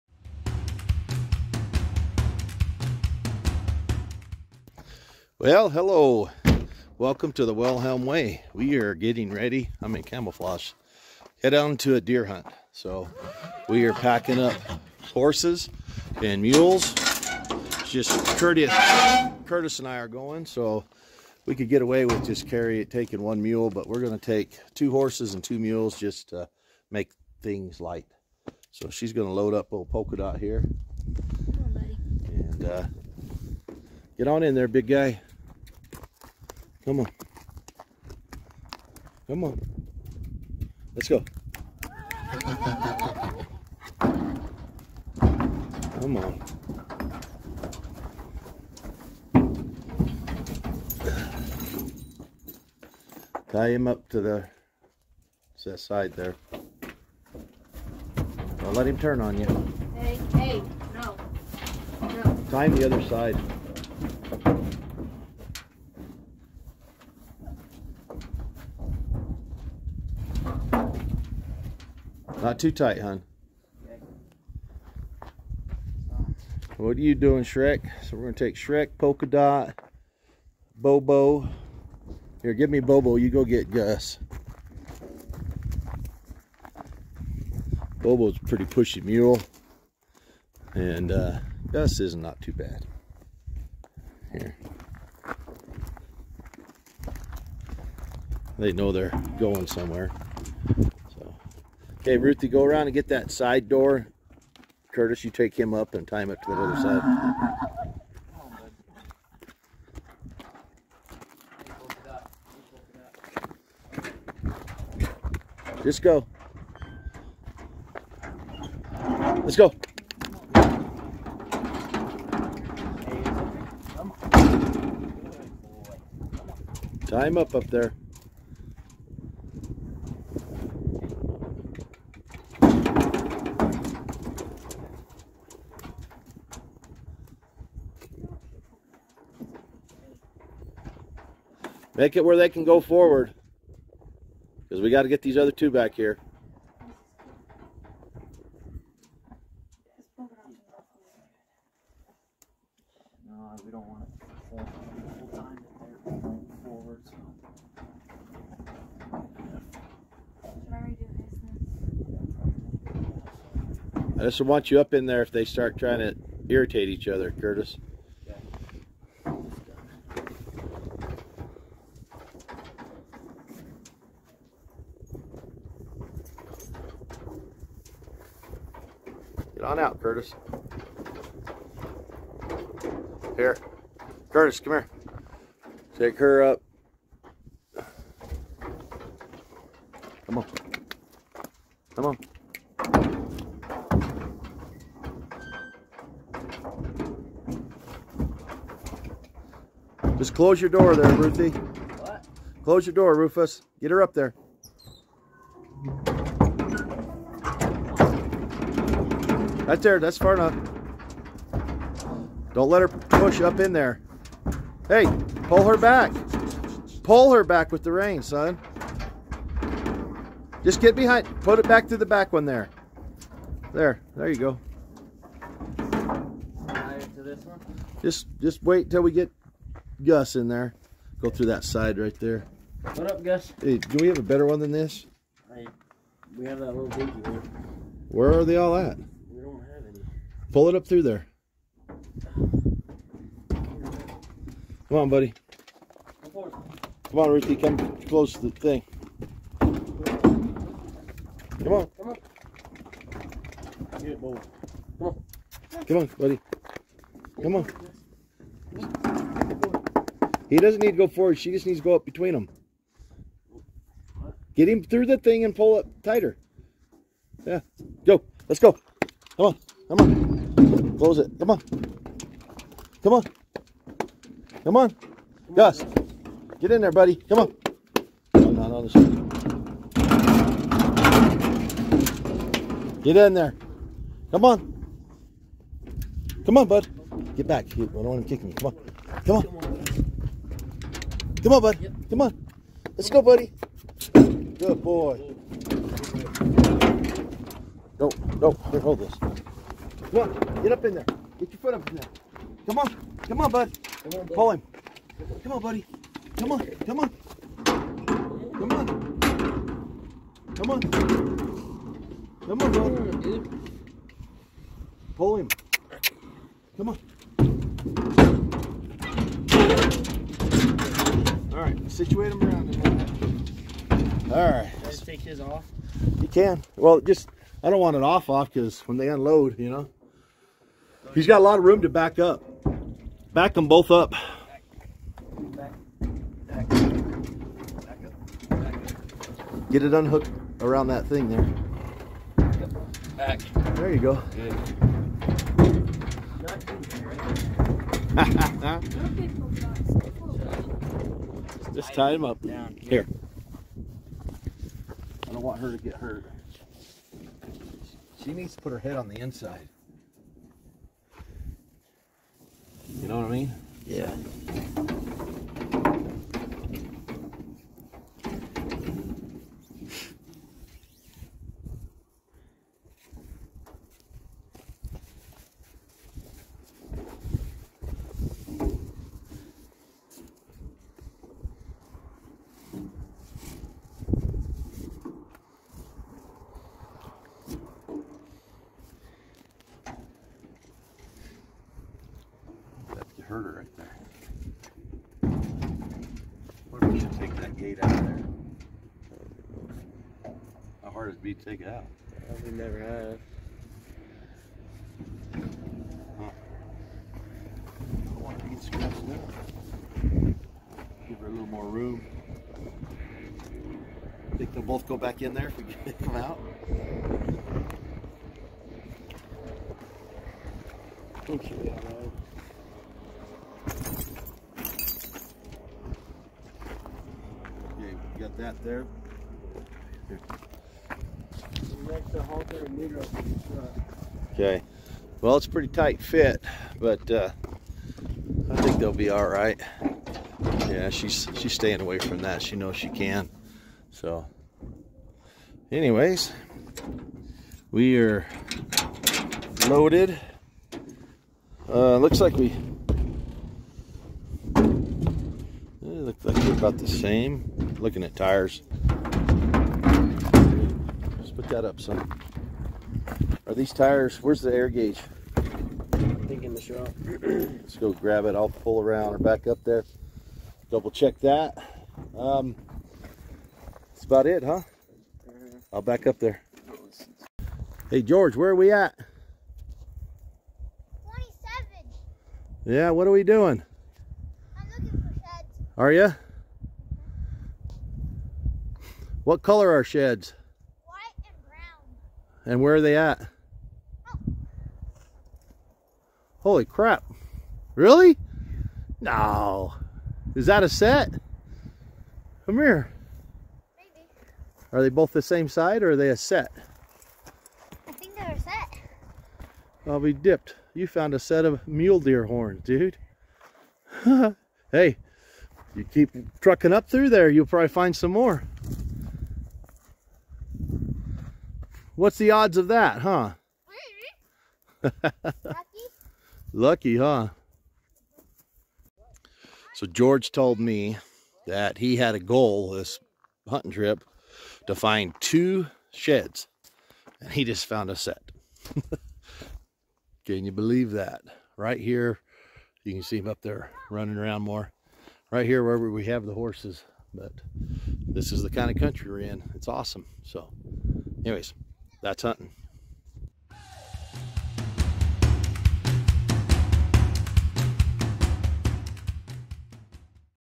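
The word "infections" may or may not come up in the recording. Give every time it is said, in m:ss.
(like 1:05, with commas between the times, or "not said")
not said.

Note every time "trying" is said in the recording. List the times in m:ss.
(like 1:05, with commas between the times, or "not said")
2:45.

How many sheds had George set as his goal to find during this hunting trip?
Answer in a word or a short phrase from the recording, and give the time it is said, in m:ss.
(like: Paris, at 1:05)
2, at 8:55.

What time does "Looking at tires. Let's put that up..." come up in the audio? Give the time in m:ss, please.
7:37.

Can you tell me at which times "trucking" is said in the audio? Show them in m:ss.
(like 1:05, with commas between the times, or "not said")
8:36.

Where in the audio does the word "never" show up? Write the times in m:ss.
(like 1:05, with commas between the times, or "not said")
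6:42.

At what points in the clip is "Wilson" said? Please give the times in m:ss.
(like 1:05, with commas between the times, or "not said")
not said.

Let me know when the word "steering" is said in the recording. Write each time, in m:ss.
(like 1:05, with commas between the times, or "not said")
not said.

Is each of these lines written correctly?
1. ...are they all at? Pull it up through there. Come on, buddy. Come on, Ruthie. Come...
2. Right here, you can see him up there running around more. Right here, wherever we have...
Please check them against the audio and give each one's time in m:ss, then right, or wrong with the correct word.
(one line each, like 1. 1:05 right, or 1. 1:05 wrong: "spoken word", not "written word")
1. 3:58 right
2. 9:01 right.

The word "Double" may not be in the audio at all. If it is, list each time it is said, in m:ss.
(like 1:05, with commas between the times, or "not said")
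7:50.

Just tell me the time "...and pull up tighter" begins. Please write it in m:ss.
4:25.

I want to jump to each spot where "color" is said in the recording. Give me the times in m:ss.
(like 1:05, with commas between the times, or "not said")
8:09.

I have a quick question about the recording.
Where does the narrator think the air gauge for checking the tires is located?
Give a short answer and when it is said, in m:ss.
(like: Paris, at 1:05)
In the shop, at 7:46.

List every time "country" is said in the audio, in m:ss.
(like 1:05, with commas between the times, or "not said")
9:08.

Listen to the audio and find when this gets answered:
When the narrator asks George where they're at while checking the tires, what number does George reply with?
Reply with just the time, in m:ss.
8:01.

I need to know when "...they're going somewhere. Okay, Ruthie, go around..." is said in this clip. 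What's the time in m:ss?
1:38.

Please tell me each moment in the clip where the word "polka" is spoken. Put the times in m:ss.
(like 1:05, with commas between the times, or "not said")
0:29, 1:18.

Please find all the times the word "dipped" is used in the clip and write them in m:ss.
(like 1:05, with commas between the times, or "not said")
8:30.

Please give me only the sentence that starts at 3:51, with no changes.
Go through that side right there.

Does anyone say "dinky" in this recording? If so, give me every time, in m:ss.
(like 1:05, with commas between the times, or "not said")
3:56.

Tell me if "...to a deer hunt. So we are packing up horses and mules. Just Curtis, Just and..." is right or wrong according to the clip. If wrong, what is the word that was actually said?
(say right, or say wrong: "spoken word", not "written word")
wrong: "Curtis", not "Just".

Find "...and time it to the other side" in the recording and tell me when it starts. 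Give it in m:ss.
1:45.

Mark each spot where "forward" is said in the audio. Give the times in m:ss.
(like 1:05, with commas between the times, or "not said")
2:22, 2:36, 4:21.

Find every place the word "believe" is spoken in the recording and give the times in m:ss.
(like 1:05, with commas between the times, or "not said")
9:00.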